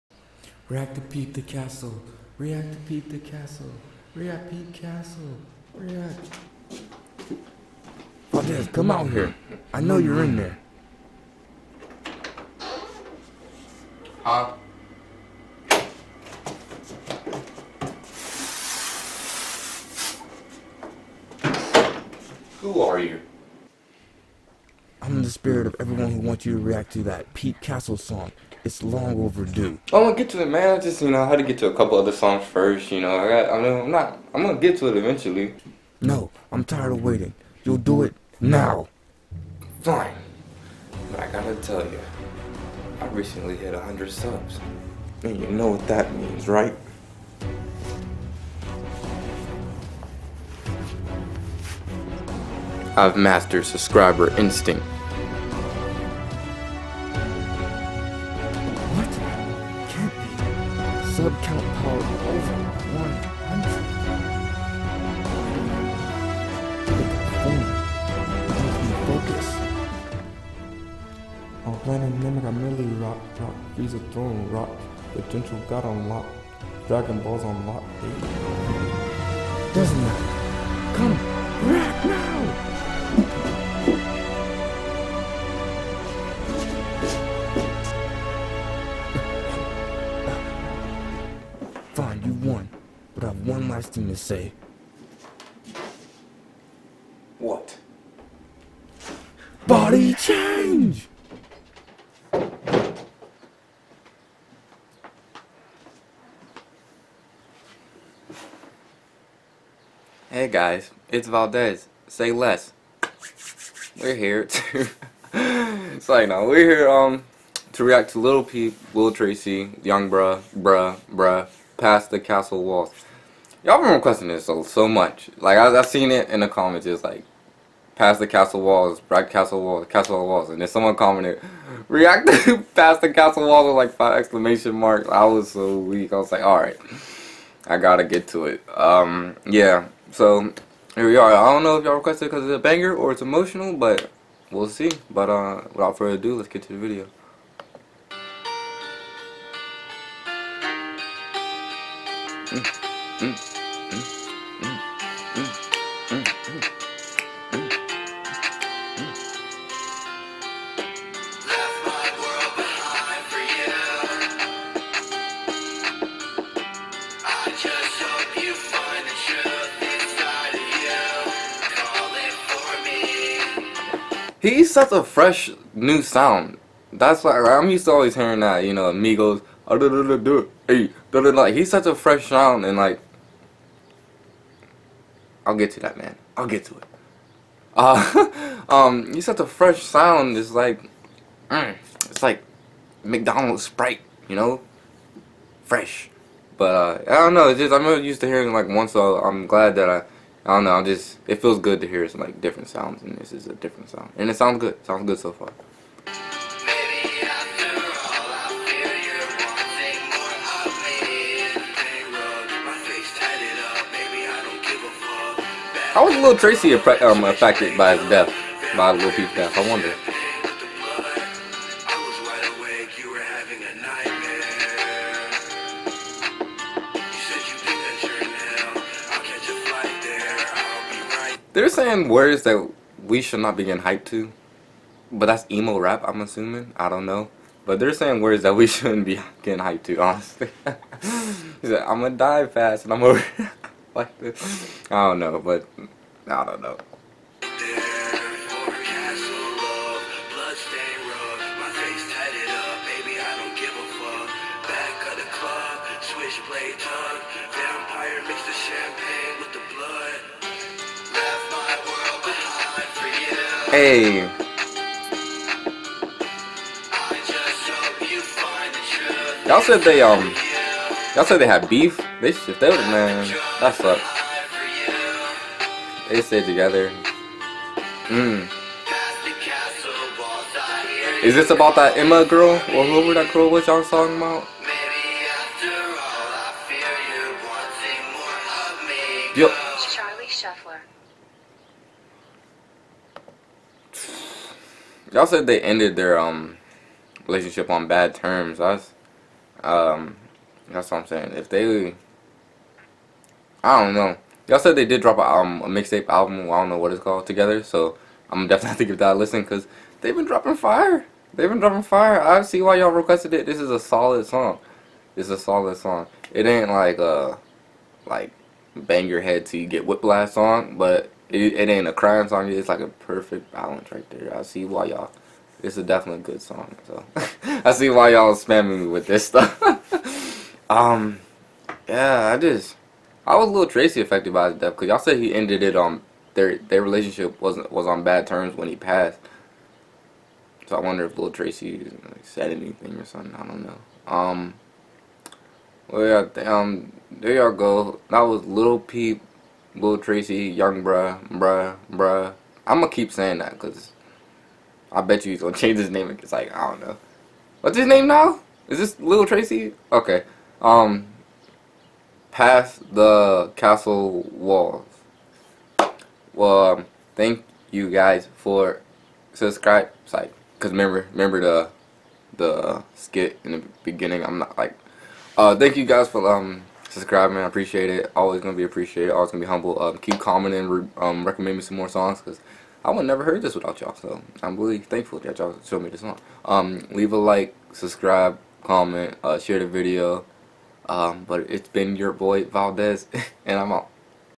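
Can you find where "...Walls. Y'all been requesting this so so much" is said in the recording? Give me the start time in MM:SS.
02:02.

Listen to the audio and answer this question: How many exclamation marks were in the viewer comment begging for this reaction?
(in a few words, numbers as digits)
5.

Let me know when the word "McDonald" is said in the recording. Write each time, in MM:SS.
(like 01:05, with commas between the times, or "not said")
03:13.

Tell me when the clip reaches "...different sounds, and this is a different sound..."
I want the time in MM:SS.
03:22.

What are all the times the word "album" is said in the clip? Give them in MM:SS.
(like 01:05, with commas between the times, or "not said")
05:06.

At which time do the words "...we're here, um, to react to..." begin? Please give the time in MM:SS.
01:56.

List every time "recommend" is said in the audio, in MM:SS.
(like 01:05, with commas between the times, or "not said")
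06:21.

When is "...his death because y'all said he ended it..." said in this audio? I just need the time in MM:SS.
05:34.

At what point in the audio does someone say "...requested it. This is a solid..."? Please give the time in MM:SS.
05:12.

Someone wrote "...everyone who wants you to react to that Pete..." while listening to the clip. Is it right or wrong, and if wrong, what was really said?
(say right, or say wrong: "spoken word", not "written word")
right.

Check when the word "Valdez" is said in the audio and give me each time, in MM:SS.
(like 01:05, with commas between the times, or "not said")
00:08, 01:51, 06:32.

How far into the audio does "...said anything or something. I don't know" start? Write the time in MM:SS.
05:42.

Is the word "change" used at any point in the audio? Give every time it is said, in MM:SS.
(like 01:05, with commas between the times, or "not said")
01:40, 05:55.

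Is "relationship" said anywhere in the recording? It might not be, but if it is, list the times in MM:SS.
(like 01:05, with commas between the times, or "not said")
04:57, 05:36.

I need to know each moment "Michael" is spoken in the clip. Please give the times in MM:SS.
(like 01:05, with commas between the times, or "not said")
not said.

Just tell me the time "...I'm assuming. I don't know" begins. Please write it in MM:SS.
03:56.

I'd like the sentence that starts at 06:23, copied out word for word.
So I'm really thankful that y'all showed me this song.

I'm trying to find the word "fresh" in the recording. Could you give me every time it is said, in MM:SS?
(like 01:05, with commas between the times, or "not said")
02:55, 03:01, 03:09, 03:15.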